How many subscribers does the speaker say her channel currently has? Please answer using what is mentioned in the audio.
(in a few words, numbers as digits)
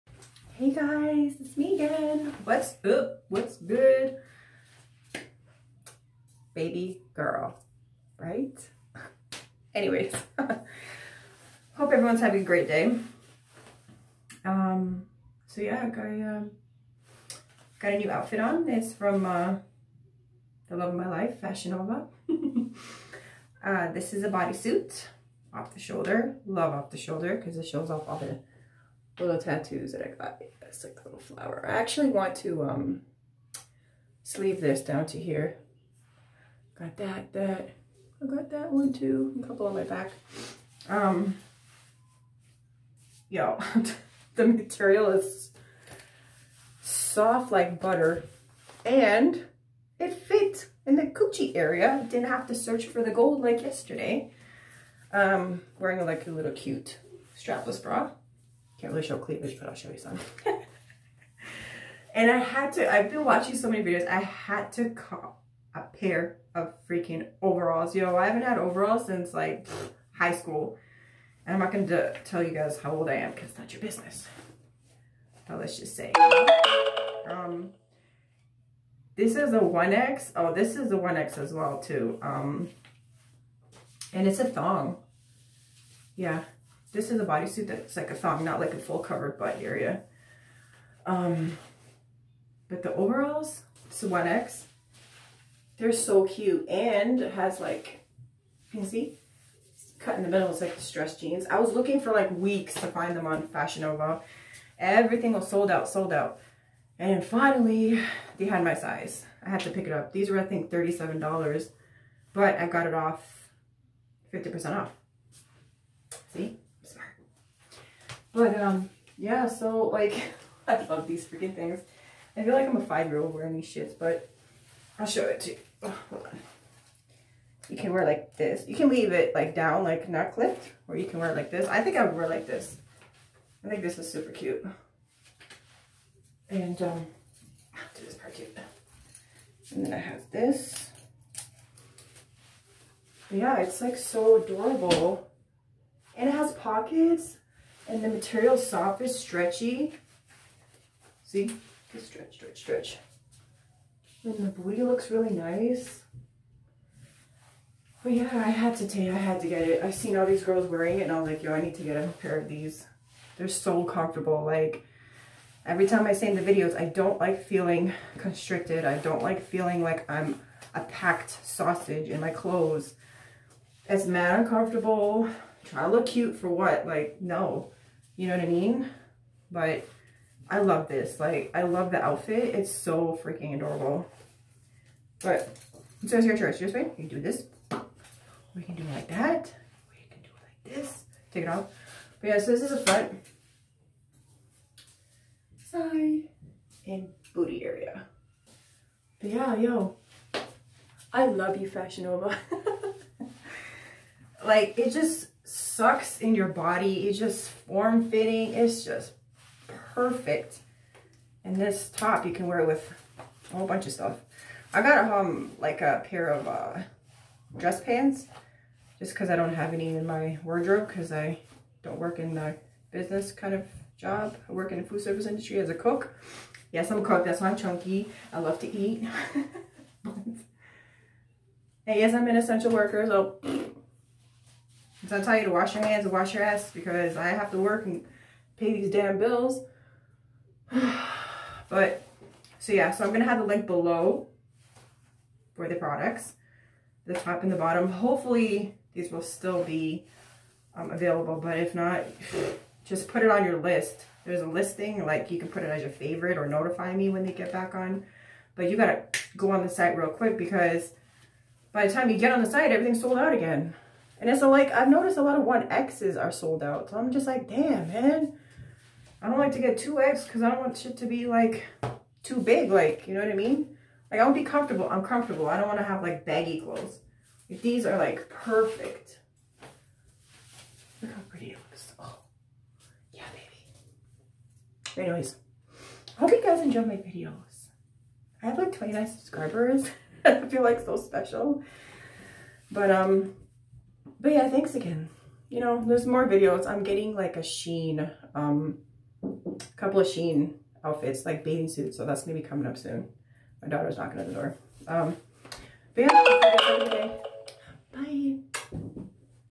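29.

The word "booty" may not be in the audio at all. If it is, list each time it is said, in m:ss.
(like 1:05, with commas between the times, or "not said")
2:34, 3:17.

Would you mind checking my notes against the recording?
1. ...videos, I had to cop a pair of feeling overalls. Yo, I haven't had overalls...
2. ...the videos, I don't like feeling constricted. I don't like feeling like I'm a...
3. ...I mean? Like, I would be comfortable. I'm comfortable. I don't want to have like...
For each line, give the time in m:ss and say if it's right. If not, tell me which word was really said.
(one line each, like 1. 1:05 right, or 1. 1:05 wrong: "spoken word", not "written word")
1. 1:03 wrong: "freaking", not "feeling"
2. 2:46 right
3. 4:33 right.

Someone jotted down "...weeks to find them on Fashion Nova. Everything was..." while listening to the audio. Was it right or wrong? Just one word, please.
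right.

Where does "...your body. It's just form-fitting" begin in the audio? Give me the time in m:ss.
3:26.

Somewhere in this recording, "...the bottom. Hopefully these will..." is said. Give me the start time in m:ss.
4:07.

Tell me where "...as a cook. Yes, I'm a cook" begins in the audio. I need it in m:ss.
3:45.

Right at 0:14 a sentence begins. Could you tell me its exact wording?
Um, so yeah, I um, got a new outfit on.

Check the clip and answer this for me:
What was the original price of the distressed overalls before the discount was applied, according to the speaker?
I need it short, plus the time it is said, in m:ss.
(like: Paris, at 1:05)
$37, at 1:50.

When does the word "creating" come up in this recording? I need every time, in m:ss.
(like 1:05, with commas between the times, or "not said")
not said.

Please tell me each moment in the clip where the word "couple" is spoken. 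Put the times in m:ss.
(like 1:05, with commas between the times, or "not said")
0:39, 4:59.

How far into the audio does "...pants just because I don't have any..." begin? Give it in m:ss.
3:37.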